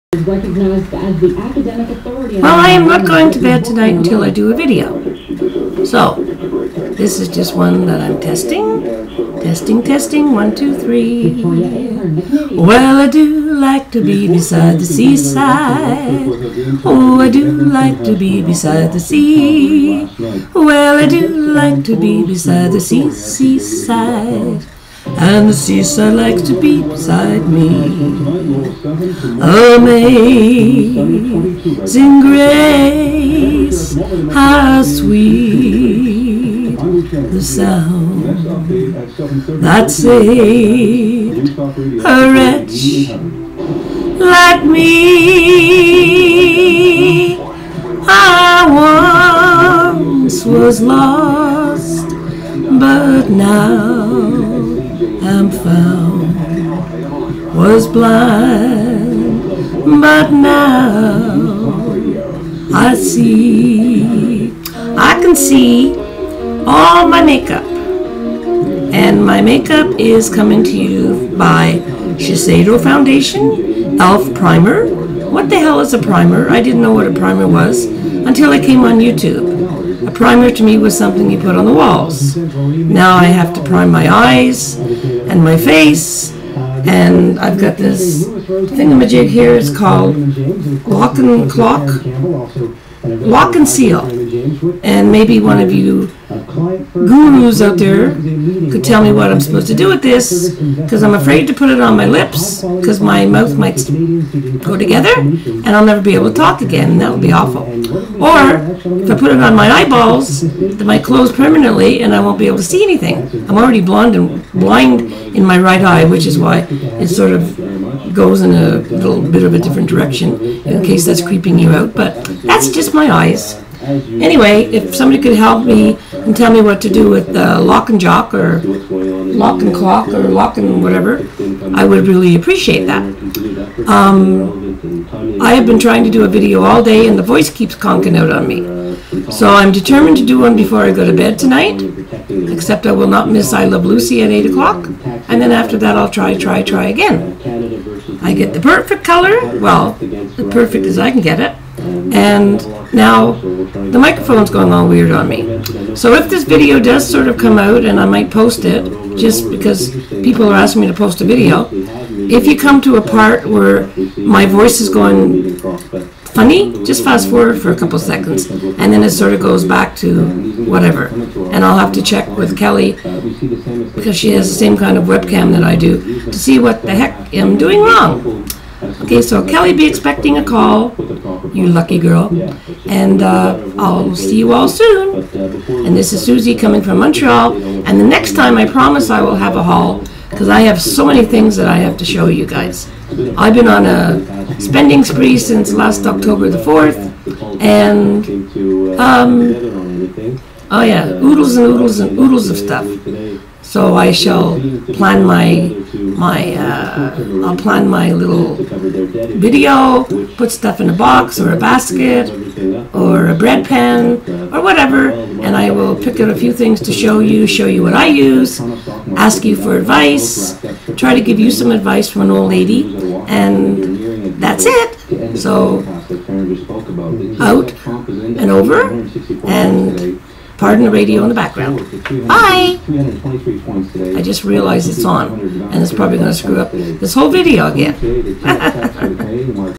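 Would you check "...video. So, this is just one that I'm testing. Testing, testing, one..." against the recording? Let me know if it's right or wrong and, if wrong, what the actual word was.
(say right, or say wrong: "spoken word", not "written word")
right.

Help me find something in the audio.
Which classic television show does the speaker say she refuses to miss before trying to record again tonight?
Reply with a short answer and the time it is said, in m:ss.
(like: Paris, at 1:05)
I Love Lucy, at 2:23.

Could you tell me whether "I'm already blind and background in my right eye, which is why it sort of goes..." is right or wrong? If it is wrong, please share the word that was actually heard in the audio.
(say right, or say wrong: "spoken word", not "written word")
wrong: "blind", not "background".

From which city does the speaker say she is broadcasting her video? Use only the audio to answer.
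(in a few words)
Montreal.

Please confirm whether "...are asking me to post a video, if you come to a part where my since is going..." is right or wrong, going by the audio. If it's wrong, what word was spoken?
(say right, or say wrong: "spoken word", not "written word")
wrong: "voice", not "since".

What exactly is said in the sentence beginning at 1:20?
A primer to me was something you put on the walls.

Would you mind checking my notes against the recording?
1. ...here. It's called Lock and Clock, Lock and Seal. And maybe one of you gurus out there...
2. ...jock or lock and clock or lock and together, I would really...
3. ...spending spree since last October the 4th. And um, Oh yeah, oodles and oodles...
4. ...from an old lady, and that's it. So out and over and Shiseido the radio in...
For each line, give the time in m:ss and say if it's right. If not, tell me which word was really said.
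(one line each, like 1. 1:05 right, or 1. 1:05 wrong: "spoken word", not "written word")
1. 1:29 right
2. 2:07 wrong: "whatever", not "together"
3. 3:14 right
4. 3:42 wrong: "Pardon", not "Shiseido".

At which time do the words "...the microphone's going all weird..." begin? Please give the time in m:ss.
2:33.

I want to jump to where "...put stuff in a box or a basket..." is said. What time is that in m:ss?
3:30.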